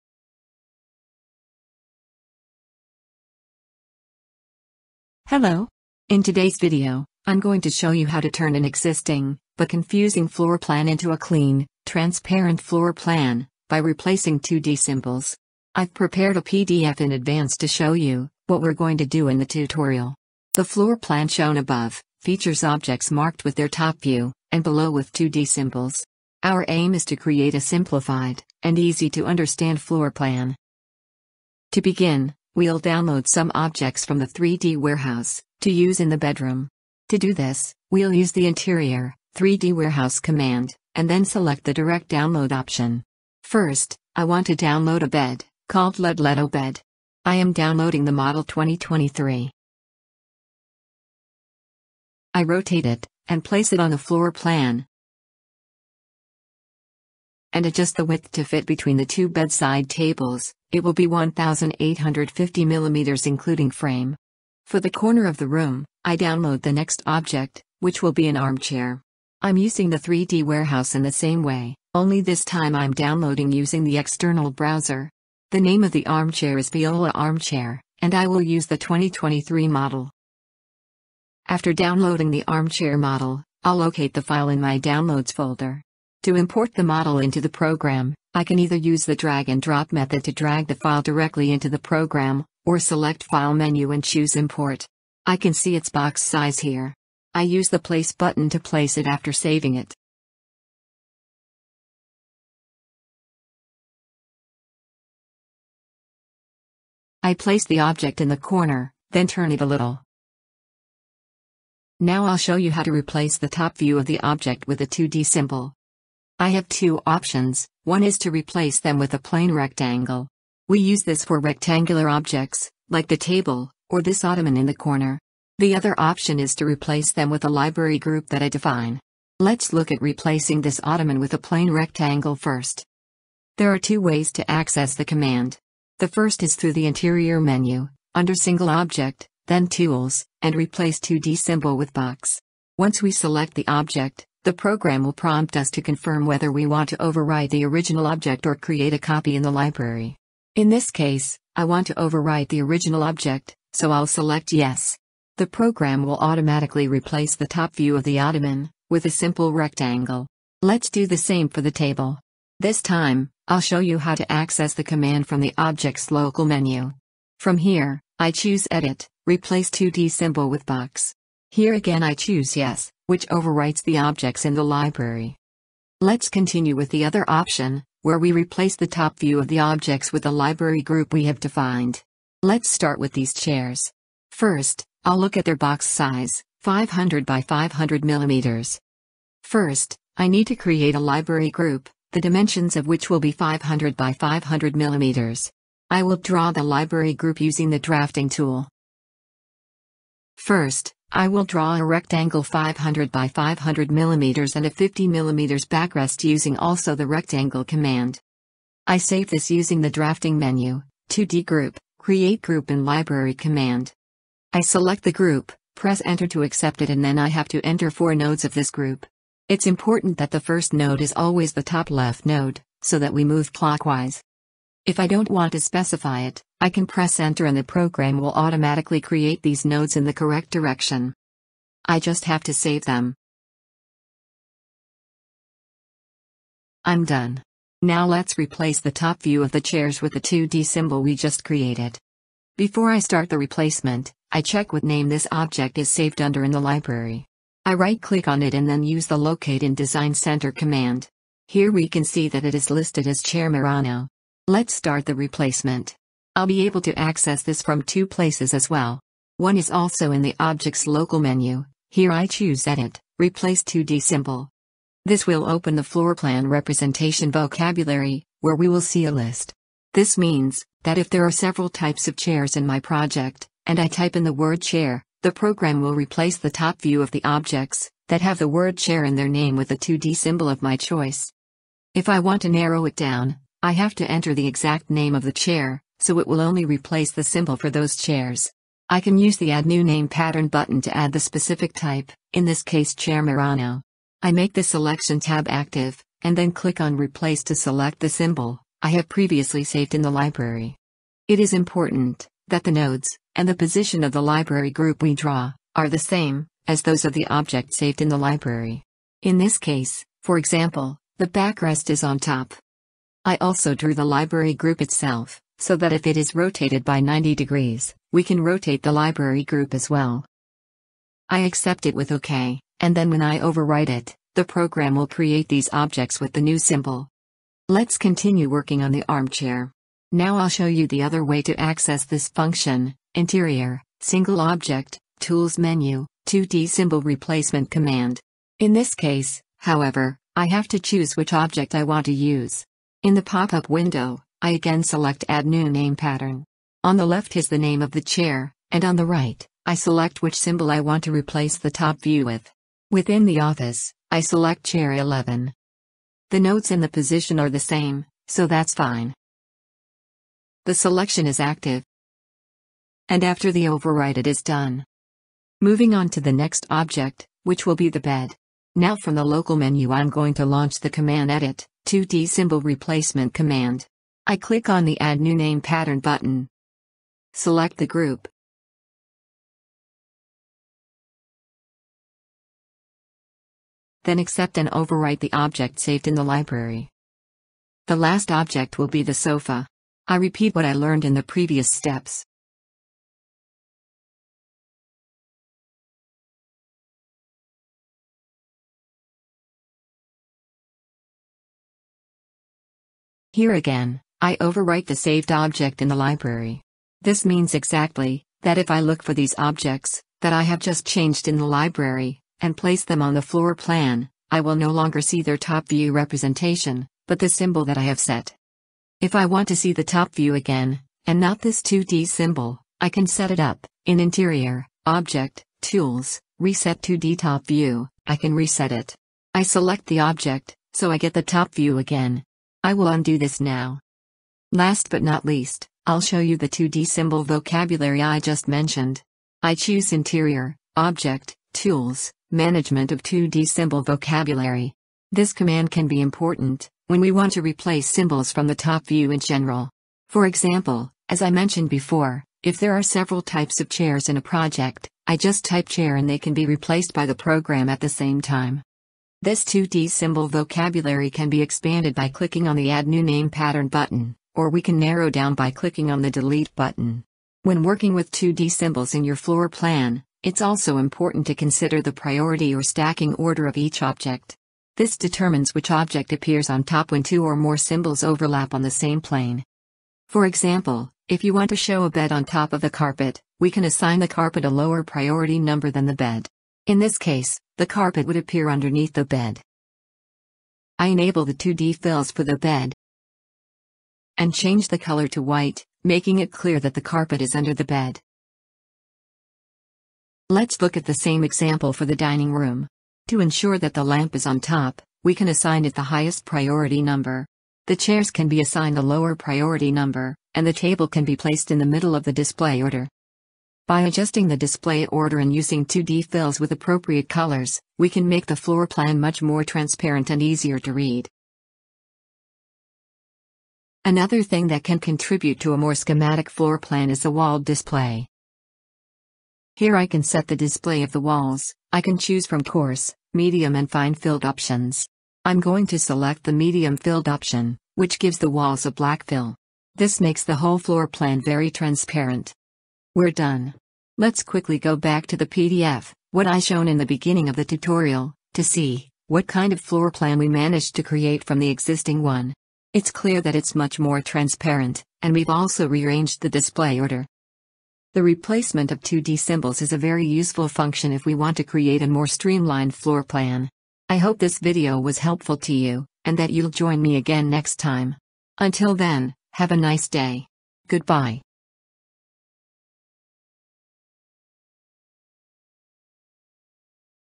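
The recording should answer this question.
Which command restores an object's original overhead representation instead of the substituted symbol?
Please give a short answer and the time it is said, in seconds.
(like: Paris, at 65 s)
Reset 2D Top View, at 426 s.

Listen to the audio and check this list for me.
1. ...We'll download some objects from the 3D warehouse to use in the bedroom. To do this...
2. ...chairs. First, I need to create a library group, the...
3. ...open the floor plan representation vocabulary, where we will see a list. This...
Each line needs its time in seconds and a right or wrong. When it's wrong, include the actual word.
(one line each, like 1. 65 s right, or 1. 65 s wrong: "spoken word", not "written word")
1. 32 s right
2. 188 s wrong: "millimeters", not "chairs"
3. 265 s right.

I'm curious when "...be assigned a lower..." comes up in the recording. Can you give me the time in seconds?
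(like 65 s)
508 s.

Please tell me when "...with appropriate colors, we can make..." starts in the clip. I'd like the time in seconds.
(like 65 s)
516 s.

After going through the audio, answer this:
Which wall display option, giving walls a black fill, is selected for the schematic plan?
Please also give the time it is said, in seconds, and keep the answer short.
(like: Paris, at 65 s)
medium filled, at 536 s.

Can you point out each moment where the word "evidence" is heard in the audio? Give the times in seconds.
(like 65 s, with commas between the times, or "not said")
not said.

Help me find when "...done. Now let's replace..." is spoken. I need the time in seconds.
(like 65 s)
237 s.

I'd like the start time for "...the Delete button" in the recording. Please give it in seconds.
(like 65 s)
466 s.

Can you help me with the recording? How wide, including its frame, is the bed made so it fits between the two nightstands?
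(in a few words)
1850 mm.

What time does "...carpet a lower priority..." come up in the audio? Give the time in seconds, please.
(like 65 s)
484 s.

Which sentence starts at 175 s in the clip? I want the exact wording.
Let's continue with the other option, where we replace the top view of the objects with the library group we have defined.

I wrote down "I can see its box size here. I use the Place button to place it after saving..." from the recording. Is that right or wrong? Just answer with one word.
right.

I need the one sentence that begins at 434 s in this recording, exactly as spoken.
Last but not least, I'll show you the 2D symbol vocabulary I just mentioned.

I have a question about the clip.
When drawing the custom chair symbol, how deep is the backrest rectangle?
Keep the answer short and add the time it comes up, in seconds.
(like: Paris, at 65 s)
50 mm, at 204 s.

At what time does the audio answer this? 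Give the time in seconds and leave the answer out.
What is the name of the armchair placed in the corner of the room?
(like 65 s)
76 s.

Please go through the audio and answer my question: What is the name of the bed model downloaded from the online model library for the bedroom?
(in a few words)
Ledleto bed.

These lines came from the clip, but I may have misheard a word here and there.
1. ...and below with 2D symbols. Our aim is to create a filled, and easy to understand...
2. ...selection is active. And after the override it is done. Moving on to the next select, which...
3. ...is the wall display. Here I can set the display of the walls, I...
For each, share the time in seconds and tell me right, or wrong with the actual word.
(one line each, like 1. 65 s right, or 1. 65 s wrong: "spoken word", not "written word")
1. 24 s wrong: "simplified", not "filled"
2. 360 s wrong: "object", not "select"
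3. 526 s right.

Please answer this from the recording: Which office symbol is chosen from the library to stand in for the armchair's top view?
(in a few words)
Chair 11.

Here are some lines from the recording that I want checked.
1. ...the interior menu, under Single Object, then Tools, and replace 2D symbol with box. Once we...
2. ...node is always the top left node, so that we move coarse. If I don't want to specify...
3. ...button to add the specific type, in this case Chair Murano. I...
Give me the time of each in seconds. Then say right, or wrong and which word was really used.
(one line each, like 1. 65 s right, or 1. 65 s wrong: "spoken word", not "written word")
1. 136 s right
2. 220 s wrong: "clockwise", not "coarse"
3. 290 s right.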